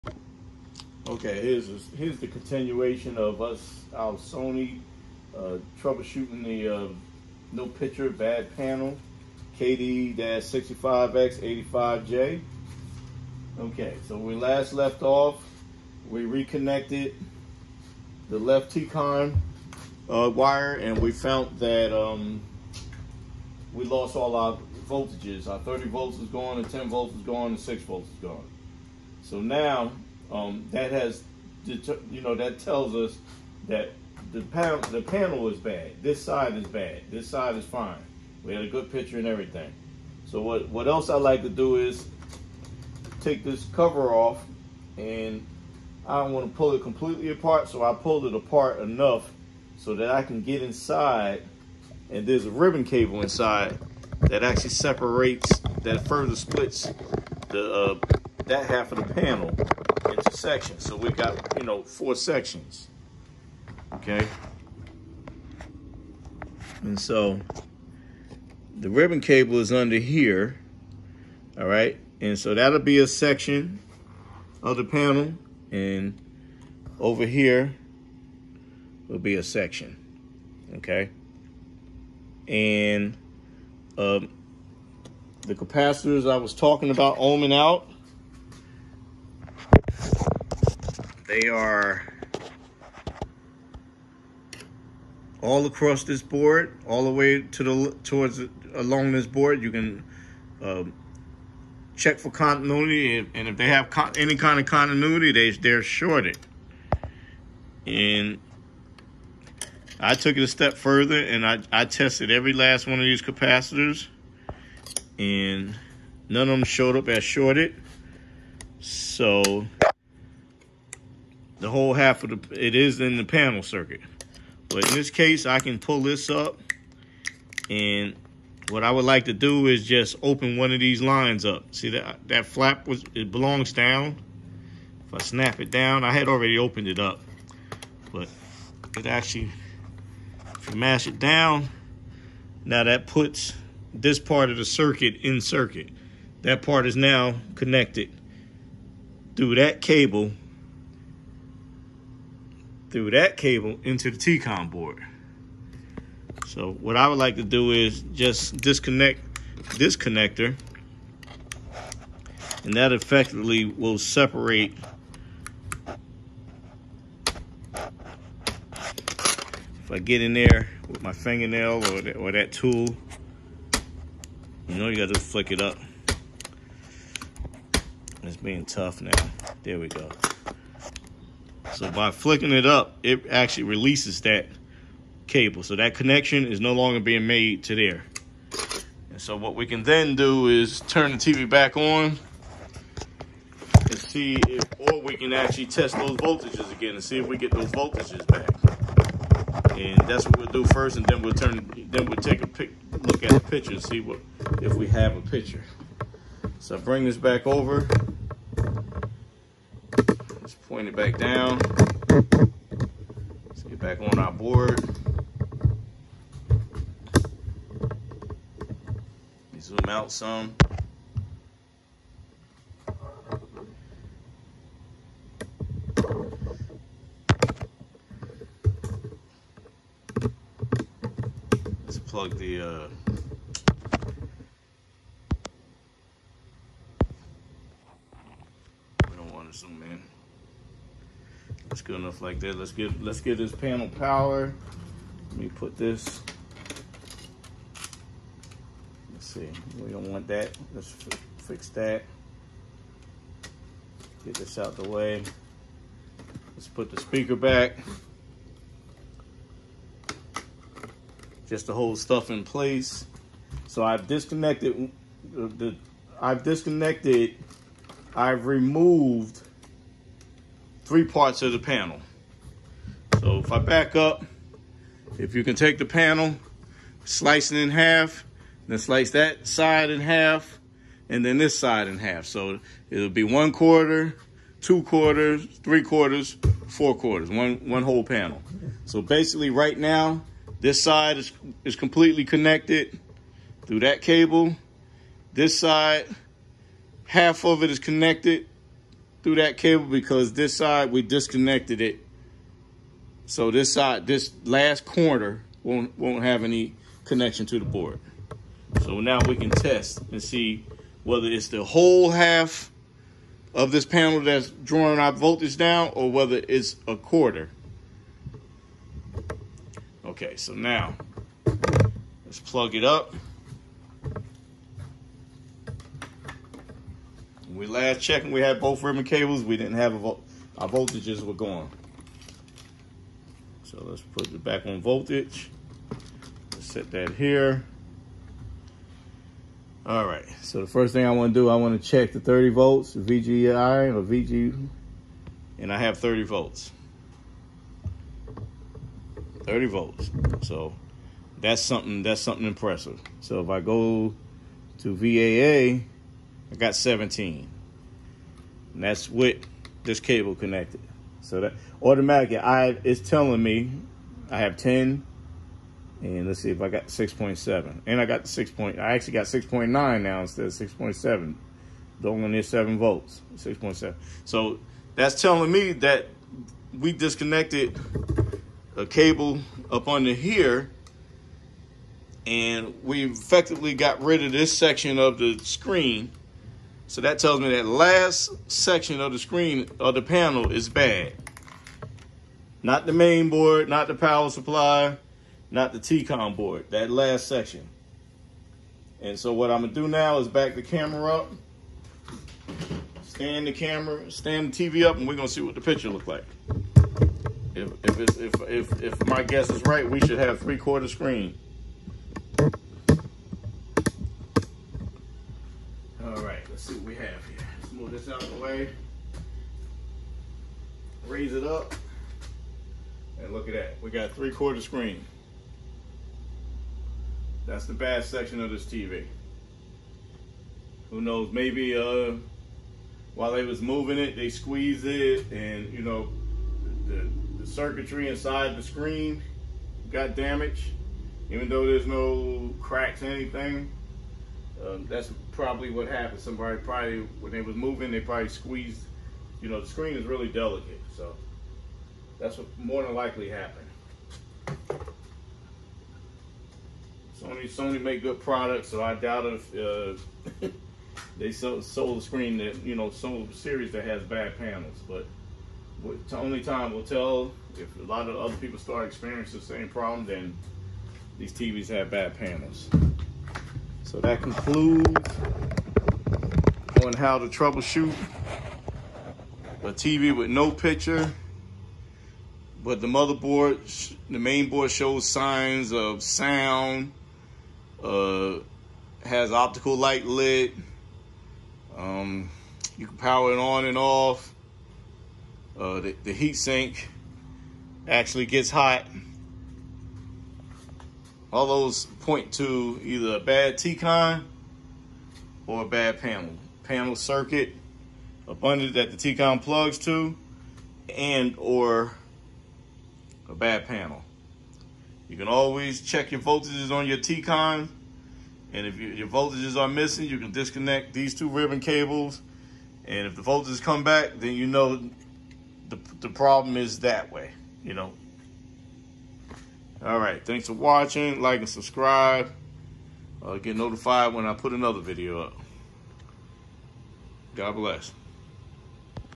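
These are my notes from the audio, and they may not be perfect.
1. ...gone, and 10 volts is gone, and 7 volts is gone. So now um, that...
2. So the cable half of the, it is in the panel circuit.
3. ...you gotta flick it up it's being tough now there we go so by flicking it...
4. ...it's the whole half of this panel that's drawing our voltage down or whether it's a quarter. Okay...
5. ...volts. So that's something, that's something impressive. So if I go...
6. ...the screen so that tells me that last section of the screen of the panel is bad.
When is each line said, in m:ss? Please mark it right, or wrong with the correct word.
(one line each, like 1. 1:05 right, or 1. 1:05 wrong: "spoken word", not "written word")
1. 0:26 wrong: "6", not "7"
2. 1:58 wrong: "whole", not "cable"
3. 2:54 right
4. 5:11 right
5. 5:49 right
6. 6:25 right.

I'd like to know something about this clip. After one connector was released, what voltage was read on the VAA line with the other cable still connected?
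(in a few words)
17.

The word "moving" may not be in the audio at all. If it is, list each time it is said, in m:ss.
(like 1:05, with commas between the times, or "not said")
7:13, 7:27.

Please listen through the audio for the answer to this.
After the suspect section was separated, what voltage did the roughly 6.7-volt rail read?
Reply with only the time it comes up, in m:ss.
6:09.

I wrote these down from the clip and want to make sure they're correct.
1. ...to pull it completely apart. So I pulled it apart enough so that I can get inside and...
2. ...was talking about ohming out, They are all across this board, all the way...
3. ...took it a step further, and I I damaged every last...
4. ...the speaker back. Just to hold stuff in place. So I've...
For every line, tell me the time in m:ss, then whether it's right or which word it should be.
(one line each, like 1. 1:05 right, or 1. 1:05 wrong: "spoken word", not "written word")
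1. 0:46 right
2. 1:26 right
3. 1:50 wrong: "tested", not "damaged"
4. 4:16 right.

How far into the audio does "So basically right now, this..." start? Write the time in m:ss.
4:48.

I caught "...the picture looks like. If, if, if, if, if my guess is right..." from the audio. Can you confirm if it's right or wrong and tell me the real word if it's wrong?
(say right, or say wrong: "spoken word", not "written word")
right.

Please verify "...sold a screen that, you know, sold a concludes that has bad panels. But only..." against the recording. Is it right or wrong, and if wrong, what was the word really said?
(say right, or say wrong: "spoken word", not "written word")
wrong: "series", not "concludes".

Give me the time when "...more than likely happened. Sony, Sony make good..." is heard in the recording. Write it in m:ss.
7:32.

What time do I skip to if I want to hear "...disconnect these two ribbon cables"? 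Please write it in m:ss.
8:40.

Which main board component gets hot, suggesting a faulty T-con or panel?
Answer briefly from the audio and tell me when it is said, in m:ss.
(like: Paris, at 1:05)
heat sink, at 8:16.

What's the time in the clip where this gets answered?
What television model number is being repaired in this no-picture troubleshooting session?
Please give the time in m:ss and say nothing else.
0:09.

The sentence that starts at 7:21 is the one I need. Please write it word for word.
Even though there's no cracks anything, um, that's probably what happened.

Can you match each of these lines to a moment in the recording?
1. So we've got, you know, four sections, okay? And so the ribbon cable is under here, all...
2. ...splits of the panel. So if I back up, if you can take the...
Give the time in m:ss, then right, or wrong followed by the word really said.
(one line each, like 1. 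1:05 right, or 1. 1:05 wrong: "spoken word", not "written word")
1. 1:00 right
2. 4:31 wrong: "parts", not "splits".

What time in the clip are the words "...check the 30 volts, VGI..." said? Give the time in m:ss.
5:41.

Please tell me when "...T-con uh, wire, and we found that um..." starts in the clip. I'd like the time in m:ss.
0:18.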